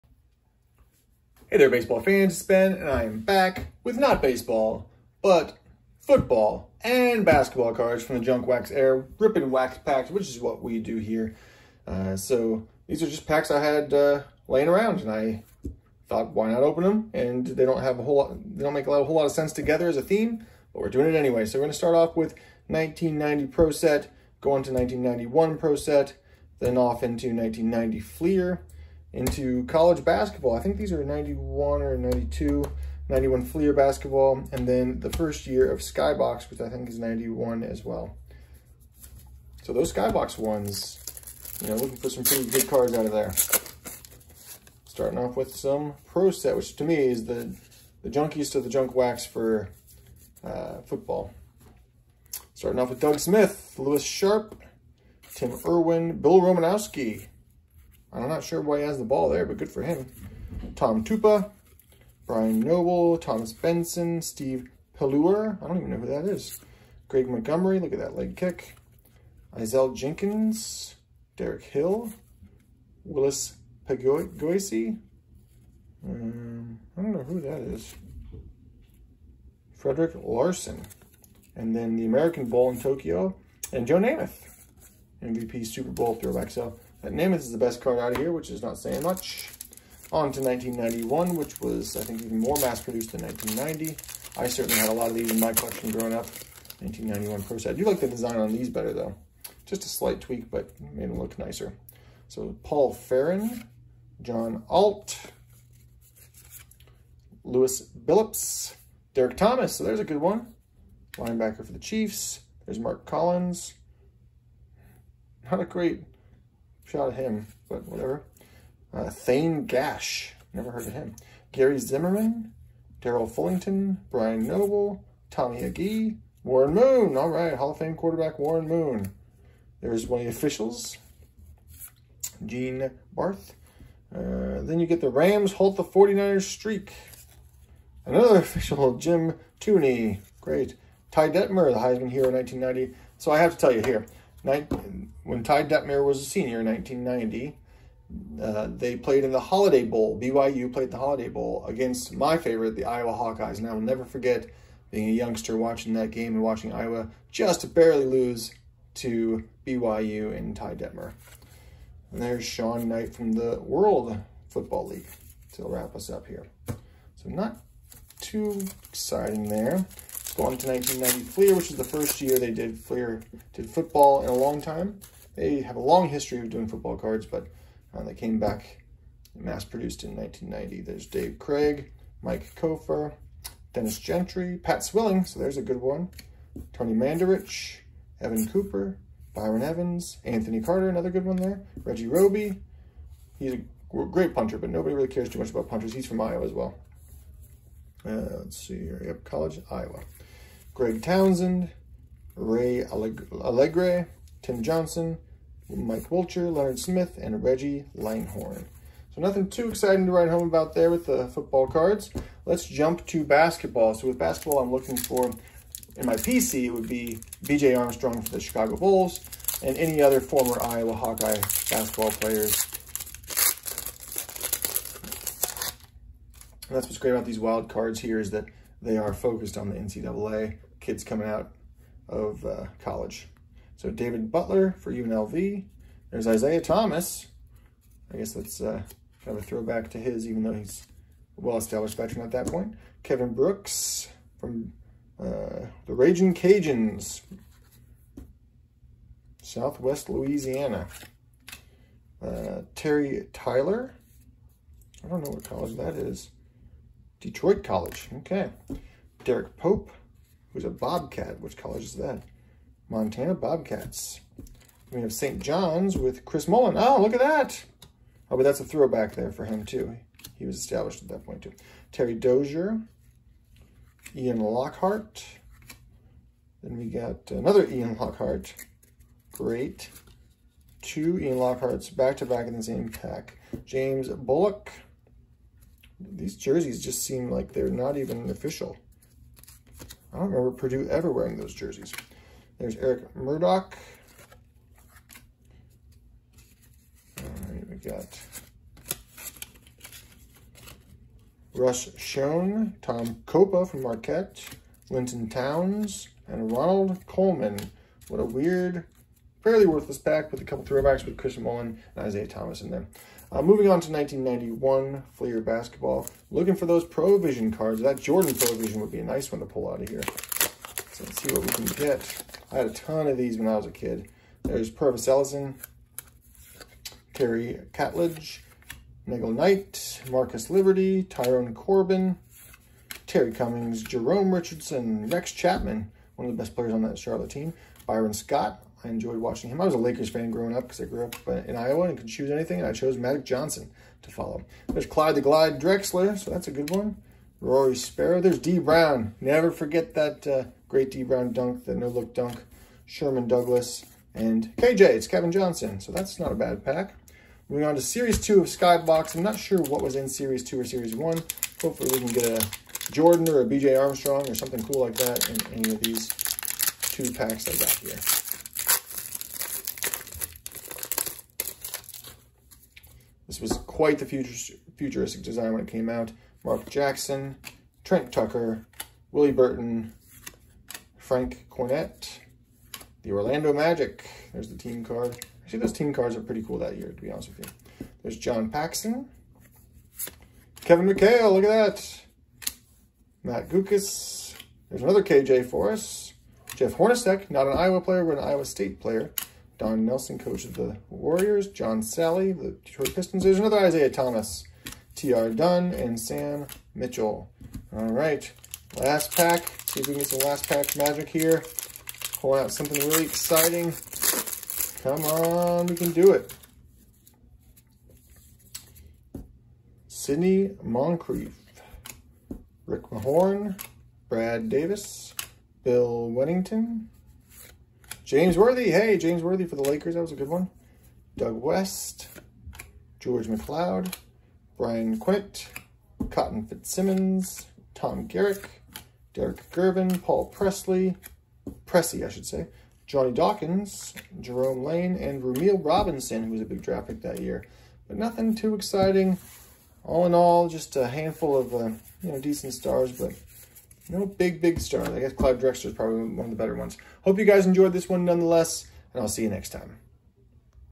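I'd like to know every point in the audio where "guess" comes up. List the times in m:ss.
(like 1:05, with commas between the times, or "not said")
3:58, 7:34.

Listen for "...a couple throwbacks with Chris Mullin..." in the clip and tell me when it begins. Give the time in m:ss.
5:10.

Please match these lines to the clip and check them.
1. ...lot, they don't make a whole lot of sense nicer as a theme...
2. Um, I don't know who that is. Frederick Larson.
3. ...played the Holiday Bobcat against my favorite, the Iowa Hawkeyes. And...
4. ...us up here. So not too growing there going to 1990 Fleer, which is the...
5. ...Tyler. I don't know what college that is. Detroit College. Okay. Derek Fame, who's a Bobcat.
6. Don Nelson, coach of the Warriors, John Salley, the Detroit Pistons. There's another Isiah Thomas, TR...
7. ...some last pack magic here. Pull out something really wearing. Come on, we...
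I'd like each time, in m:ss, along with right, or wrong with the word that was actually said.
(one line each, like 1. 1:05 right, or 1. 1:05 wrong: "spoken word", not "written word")
1. 0:18 wrong: "together", not "nicer"
2. 1:16 right
3. 2:30 wrong: "Bowl", not "Bobcat"
4. 2:45 wrong: "exciting", not "growing"
5. 4:13 wrong: "Pope", not "Fame"
6. 6:39 right
7. 6:50 wrong: "exciting", not "wearing".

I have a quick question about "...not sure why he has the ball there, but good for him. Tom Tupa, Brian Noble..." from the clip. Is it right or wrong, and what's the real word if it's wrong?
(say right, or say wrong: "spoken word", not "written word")
right.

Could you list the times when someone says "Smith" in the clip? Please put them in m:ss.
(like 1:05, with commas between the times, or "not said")
0:53, 3:26.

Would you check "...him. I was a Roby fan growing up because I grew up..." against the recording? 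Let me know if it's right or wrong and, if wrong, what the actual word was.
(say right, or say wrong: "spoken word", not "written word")
wrong: "Lakers", not "Roby".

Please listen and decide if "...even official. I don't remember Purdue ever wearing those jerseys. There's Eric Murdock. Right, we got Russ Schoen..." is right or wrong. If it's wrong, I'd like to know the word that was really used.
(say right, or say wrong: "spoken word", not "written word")
right.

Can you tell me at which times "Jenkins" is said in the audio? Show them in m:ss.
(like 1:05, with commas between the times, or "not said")
1:09.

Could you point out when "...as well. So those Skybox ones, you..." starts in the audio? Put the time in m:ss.
0:37.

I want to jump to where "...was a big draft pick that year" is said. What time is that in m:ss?
7:26.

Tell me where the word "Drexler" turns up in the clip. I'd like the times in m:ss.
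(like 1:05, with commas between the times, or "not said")
5:45, 7:35.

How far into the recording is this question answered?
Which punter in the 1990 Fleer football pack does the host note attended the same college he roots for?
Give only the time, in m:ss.
3:11.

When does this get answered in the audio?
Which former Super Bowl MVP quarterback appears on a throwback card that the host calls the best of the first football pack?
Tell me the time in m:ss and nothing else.
1:23.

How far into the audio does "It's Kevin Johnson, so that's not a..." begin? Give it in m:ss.
5:54.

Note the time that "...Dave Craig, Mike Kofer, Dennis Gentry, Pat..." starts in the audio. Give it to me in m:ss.
3:01.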